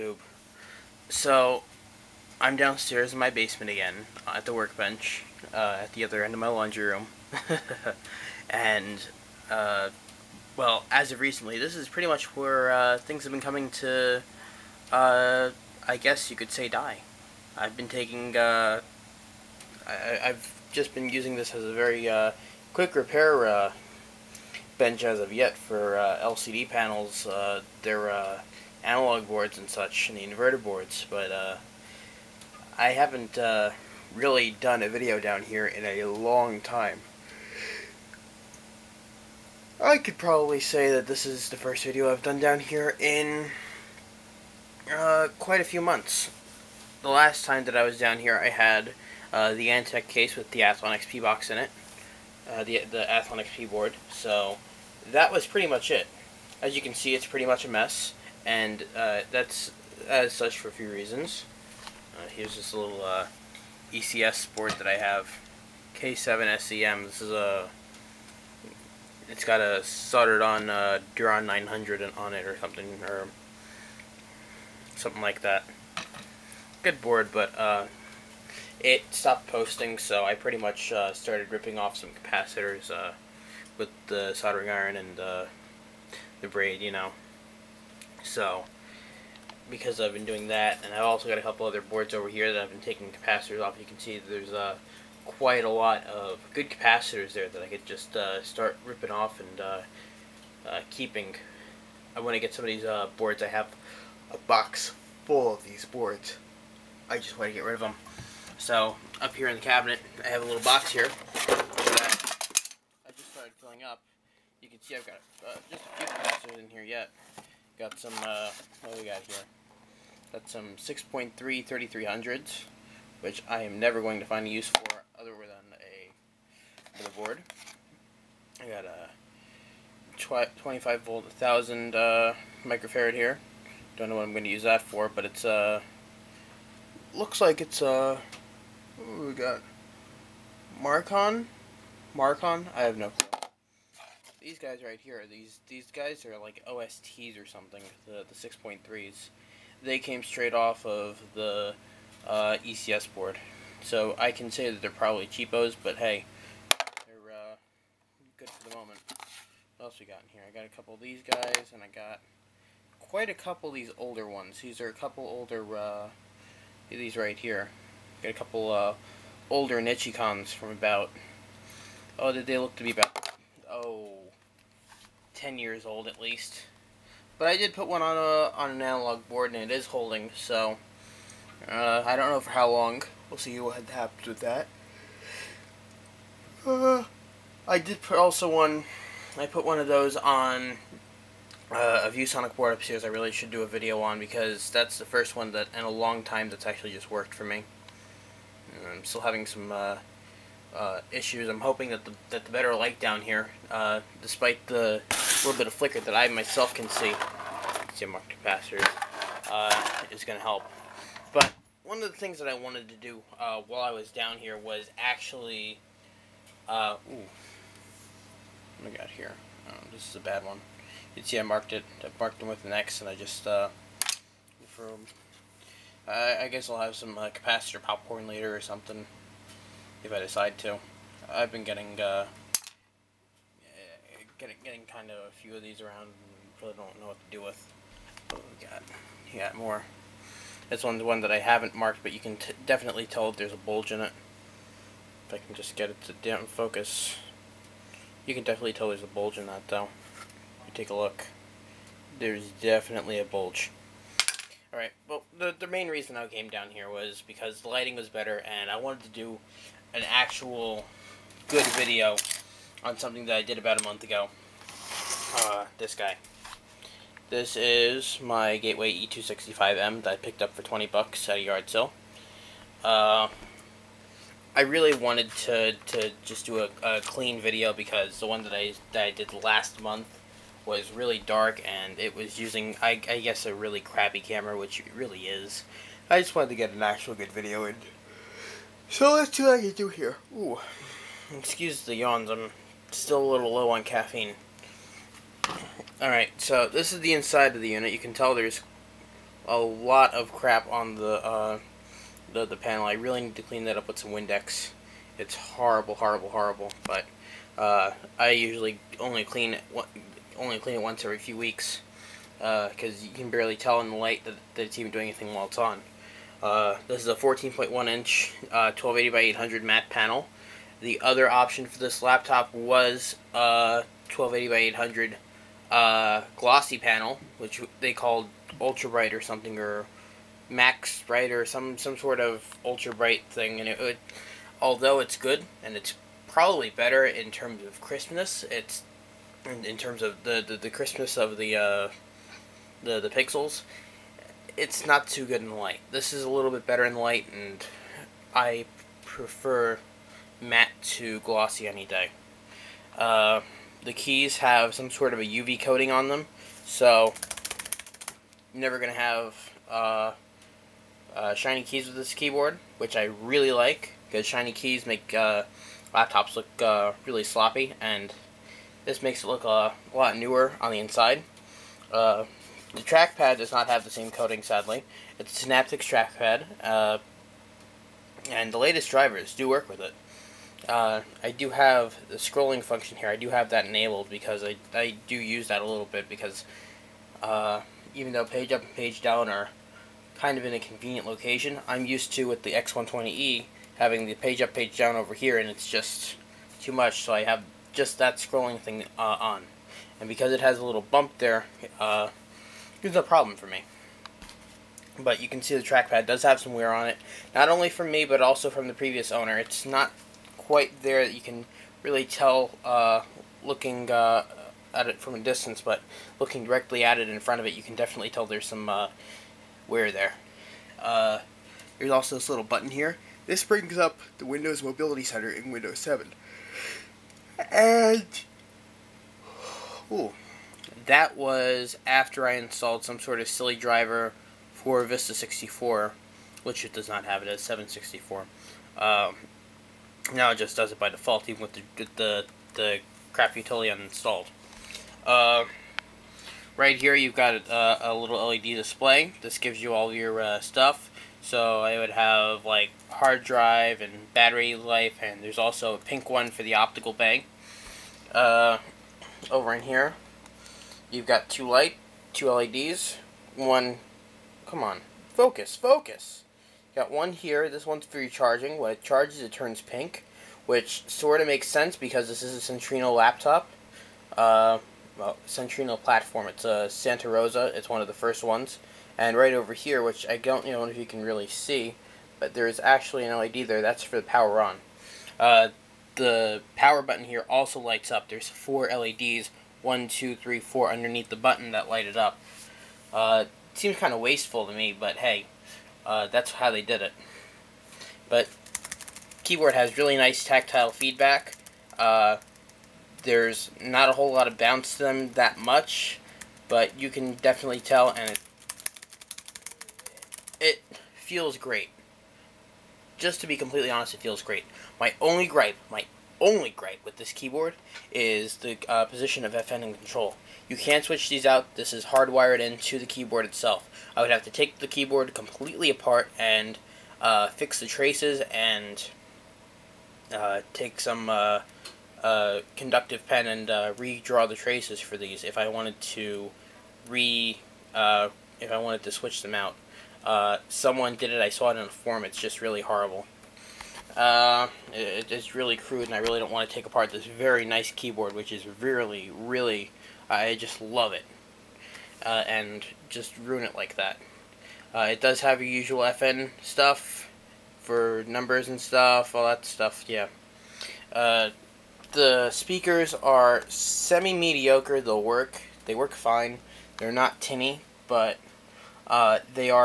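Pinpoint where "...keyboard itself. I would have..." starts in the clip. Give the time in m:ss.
8:42.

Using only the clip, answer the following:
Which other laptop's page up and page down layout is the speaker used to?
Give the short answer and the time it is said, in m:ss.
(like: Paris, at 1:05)
X120E, at 6:32.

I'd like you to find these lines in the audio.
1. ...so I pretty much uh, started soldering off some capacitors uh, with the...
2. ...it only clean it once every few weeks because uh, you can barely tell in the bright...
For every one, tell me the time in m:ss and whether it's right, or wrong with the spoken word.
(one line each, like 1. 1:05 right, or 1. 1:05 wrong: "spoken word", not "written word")
1. 1:19 wrong: "ripping", not "soldering"
2. 5:09 wrong: "light", not "bright".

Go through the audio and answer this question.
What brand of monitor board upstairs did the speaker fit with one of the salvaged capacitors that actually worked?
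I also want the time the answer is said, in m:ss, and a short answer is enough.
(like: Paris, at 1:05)
ViewSonic, at 3:12.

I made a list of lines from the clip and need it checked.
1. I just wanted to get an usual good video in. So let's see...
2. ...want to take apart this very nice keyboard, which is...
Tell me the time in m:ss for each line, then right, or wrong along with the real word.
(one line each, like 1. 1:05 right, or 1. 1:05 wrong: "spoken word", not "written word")
1. 4:46 wrong: "actual", not "usual"
2. 9:06 right.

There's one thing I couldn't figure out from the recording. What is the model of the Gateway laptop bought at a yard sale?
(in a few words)
E265M.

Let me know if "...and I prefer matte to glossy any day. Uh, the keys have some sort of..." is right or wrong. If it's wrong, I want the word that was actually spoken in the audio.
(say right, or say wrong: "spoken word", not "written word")
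right.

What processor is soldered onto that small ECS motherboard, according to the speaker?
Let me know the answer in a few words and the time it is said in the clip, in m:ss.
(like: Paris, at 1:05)
Duron 900, at 1:11.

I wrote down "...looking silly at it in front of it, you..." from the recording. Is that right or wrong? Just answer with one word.
wrong.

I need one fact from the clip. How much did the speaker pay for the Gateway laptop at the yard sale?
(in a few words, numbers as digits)
$20.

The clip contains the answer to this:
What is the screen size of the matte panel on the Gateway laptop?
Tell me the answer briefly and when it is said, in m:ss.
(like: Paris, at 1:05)
14.1 inch, at 5:17.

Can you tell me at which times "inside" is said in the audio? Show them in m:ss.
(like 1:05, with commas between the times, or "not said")
4:57, 6:10.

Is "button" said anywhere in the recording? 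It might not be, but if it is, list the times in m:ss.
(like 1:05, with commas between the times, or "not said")
7:02, 8:06, 8:11.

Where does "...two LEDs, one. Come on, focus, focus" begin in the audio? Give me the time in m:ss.
7:42.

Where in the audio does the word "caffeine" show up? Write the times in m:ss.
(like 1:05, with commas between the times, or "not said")
4:53.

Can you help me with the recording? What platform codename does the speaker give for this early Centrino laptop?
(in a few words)
Santa Rosa.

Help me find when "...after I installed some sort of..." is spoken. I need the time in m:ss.
7:11.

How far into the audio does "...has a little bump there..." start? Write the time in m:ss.
6:40.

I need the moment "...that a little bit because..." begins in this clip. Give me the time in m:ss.
6:25.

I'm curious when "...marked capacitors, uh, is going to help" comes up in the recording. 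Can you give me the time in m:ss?
3:28.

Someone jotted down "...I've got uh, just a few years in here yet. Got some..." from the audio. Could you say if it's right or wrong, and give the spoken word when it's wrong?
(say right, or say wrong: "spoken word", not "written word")
wrong: "capacitors", not "years".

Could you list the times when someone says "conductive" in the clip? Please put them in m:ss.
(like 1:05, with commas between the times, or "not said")
8:52.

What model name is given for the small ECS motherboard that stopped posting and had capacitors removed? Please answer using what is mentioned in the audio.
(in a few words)
K7SEM.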